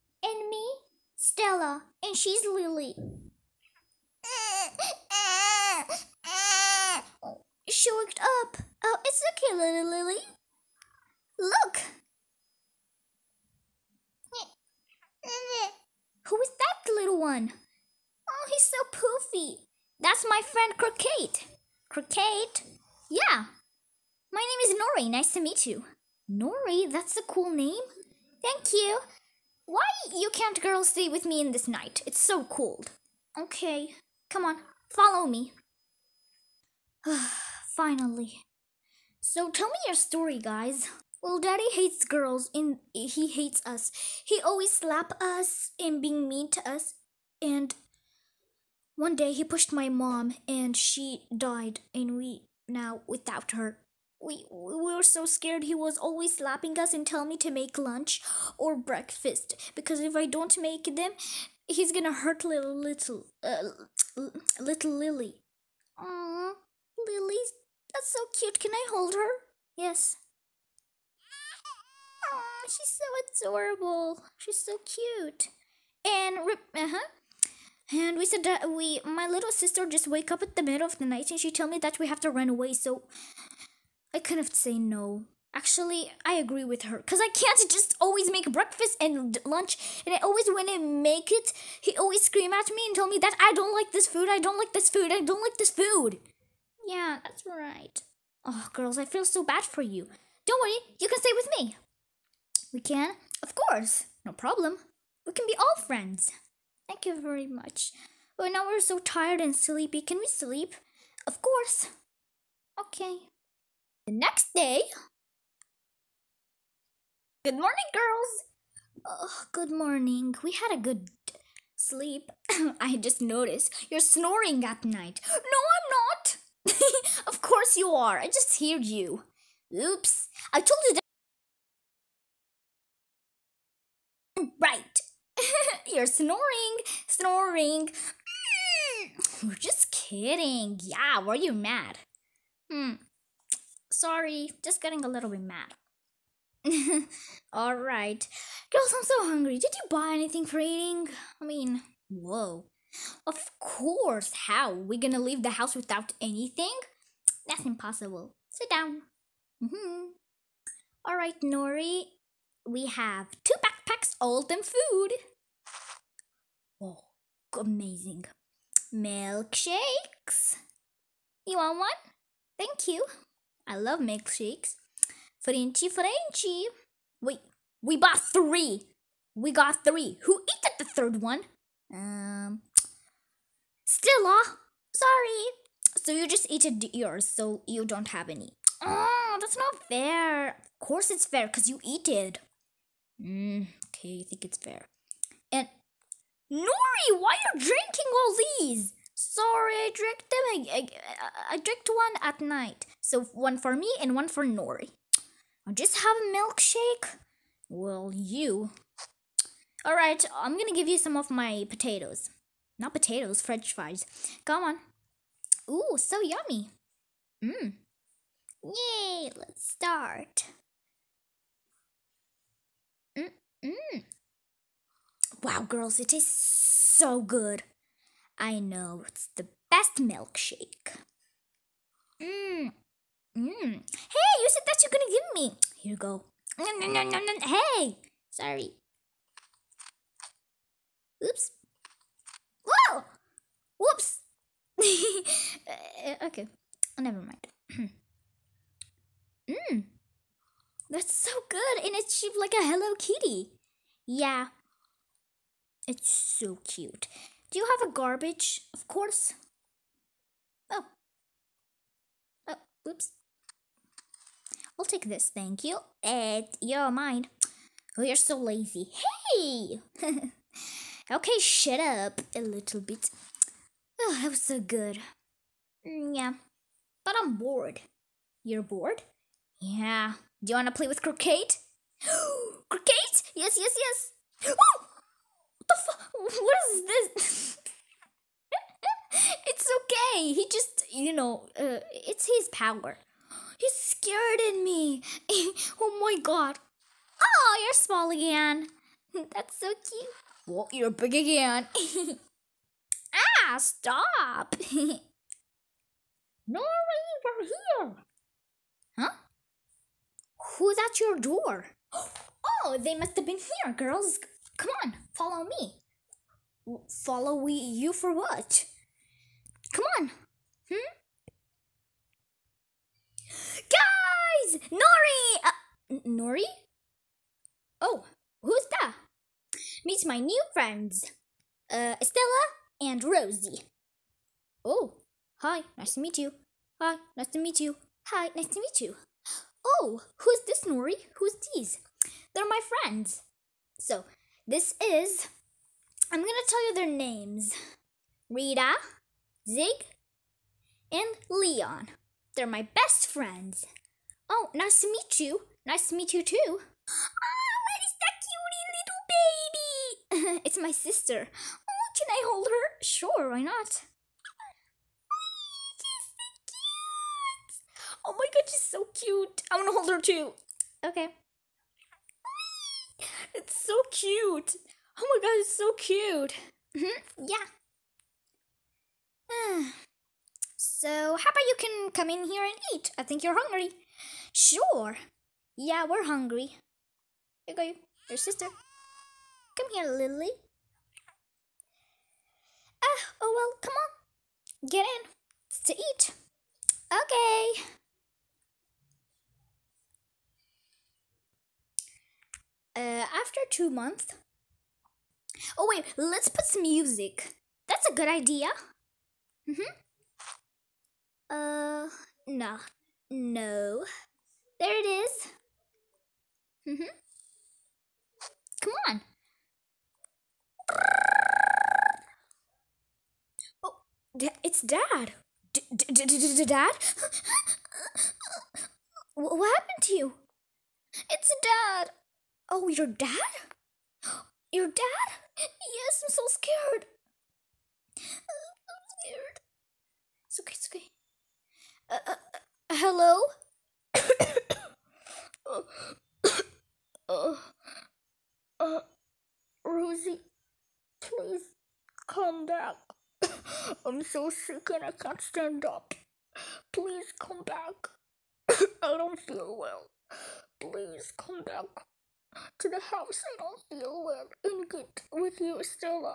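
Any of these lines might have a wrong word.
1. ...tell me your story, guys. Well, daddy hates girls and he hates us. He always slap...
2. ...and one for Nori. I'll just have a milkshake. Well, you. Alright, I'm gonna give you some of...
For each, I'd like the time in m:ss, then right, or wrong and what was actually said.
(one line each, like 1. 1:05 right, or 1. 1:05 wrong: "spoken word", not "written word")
1. 0:39 right
2. 3:24 right.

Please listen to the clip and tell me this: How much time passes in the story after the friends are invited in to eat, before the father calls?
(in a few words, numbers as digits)
2 months.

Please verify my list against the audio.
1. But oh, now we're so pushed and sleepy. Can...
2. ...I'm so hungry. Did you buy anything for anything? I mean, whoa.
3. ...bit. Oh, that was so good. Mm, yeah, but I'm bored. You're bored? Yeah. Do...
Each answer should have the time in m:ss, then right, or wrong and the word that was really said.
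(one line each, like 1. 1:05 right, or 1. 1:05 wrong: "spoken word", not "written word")
1. 1:48 wrong: "tired", not "pushed"
2. 2:28 wrong: "eating", not "anything"
3. 4:32 right.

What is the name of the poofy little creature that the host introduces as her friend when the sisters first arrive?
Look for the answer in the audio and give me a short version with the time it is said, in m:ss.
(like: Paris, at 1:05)
Croquette, at 0:19.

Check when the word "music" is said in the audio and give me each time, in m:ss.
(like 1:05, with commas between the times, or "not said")
6:46.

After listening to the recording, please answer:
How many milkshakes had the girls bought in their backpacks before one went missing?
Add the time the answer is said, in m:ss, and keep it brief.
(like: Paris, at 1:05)
3, at 2:57.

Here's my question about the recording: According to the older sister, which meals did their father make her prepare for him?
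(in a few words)
lunch or breakfast.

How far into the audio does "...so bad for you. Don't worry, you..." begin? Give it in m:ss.
1:39.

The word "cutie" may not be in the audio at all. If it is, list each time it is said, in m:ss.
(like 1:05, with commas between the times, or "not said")
6:00.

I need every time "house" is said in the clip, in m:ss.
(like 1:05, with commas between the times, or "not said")
2:35, 7:42.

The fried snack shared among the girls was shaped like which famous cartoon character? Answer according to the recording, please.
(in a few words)
Hello Kitty.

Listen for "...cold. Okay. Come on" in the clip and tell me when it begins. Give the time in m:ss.
0:32.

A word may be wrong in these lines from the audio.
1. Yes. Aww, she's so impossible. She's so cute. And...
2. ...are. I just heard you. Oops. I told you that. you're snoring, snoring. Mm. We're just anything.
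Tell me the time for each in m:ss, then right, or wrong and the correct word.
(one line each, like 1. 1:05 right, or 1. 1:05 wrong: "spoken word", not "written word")
1. 1:09 wrong: "adorable", not "impossible"
2. 2:07 wrong: "kidding", not "anything".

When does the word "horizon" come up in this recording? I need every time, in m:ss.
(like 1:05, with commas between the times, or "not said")
not said.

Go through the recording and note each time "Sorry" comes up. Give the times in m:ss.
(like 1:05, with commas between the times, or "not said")
2:23, 3:04, 3:19, 3:58.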